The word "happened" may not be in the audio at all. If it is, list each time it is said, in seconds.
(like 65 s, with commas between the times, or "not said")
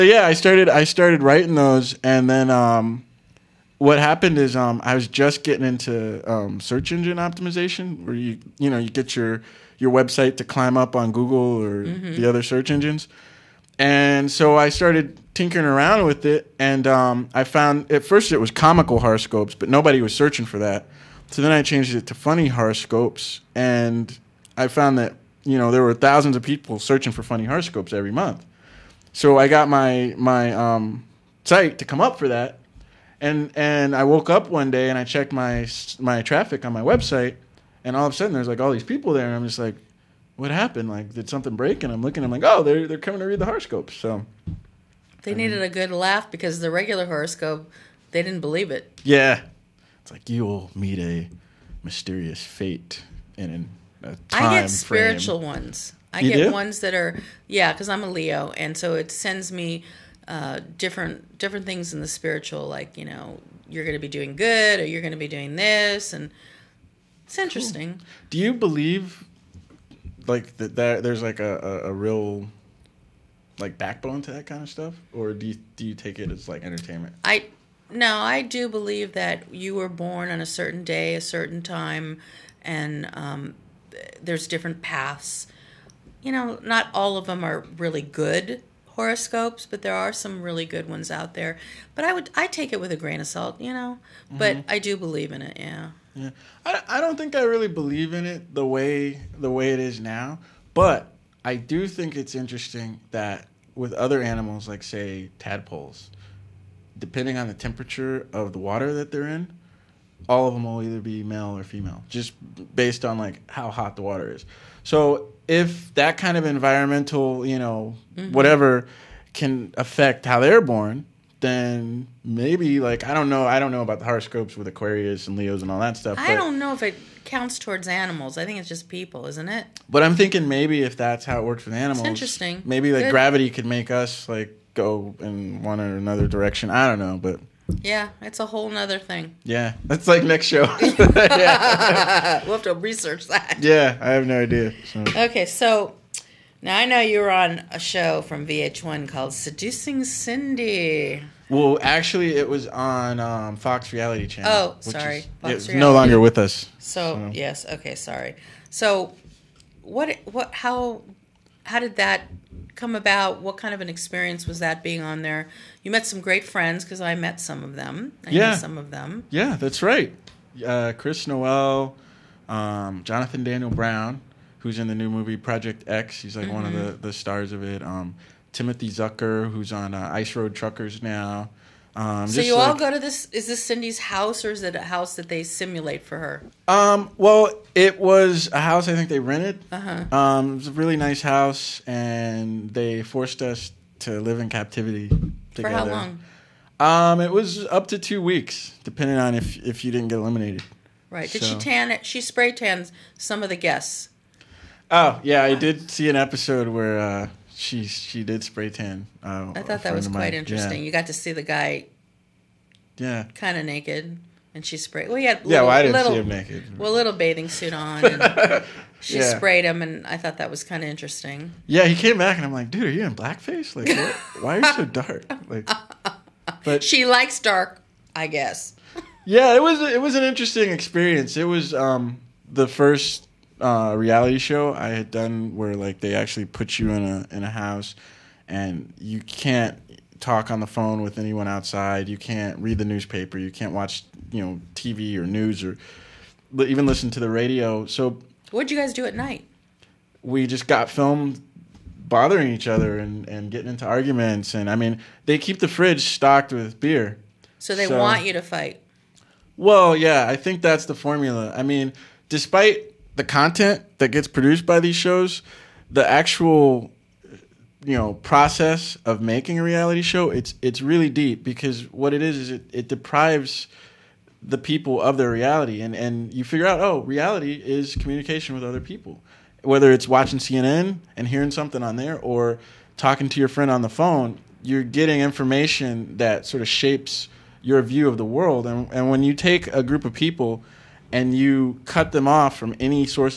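3 s, 40 s.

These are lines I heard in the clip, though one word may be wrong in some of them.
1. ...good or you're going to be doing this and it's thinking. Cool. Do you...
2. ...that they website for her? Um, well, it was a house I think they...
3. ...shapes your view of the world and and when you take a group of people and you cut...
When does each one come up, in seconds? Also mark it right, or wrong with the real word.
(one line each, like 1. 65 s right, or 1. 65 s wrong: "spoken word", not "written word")
1. 64 s wrong: "interesting", not "thinking"
2. 185 s wrong: "simulate", not "website"
3. 286 s right.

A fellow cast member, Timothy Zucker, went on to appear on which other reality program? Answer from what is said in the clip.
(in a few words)
Ice Road Truckers.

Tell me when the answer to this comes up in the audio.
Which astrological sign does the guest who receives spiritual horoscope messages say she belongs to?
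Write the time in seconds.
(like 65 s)
58 s.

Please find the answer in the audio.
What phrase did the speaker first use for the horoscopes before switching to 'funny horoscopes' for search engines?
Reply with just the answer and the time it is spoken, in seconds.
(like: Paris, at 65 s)
comical horoscopes, at 18 s.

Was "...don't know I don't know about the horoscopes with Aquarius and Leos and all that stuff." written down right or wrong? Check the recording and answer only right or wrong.
right.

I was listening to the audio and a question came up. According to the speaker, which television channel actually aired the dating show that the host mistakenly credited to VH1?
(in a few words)
Fox Reality Channel.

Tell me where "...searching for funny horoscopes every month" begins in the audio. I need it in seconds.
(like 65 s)
26 s.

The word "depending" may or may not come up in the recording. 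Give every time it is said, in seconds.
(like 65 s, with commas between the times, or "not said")
106 s, 198 s.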